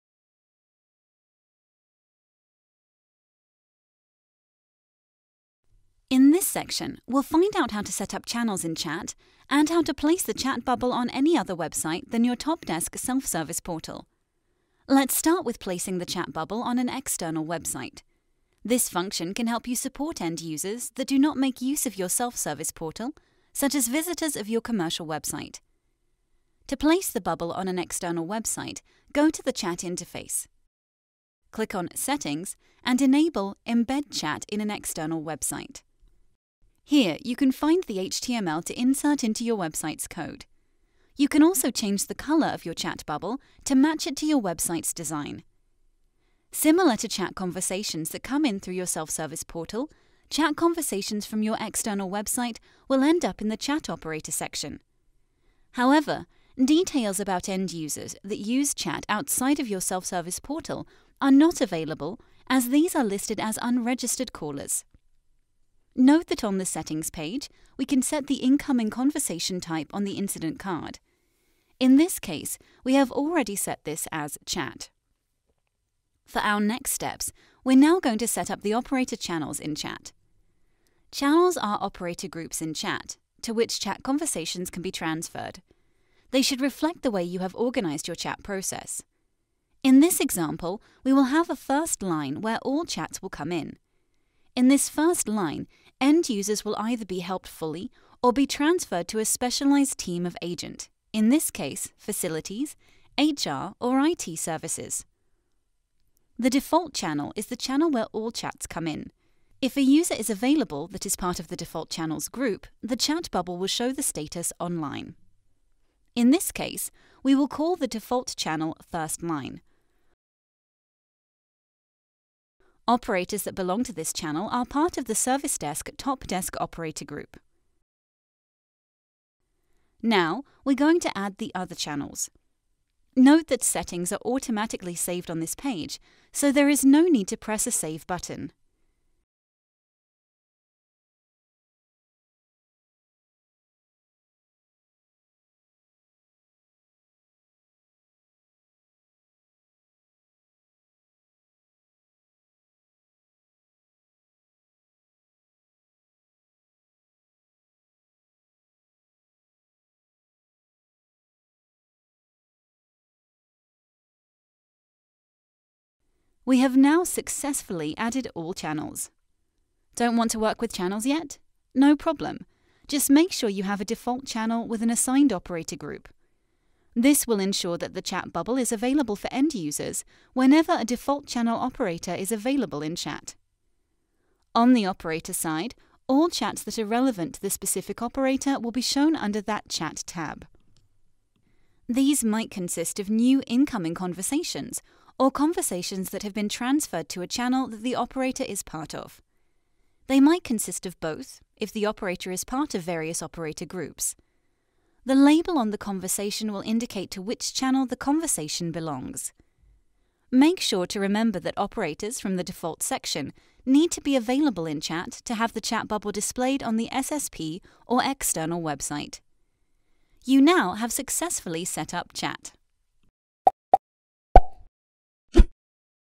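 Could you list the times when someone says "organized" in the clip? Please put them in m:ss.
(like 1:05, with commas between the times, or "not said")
1:27.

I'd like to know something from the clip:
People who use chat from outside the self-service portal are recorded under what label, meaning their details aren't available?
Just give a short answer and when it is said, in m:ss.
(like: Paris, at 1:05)
unregistered callers, at 1:03.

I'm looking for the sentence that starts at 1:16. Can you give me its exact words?
For our next steps, we're now going to set up the operator channels in chat.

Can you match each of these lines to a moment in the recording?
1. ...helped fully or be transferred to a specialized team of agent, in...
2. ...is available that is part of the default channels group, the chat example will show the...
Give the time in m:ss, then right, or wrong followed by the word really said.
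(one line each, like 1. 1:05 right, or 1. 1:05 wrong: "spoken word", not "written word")
1. 1:37 right
2. 1:50 wrong: "bubble", not "example".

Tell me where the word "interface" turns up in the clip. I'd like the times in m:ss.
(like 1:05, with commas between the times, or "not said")
0:29.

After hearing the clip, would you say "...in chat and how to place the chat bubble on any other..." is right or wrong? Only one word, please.
right.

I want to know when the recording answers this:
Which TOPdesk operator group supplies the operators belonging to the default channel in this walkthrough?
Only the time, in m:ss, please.
2:05.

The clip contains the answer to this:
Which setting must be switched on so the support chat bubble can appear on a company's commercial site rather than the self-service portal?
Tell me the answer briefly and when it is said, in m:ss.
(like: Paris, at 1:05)
Embed Chat in an external website, at 0:33.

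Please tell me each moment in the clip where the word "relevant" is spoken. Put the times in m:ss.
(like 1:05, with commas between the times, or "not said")
3:06.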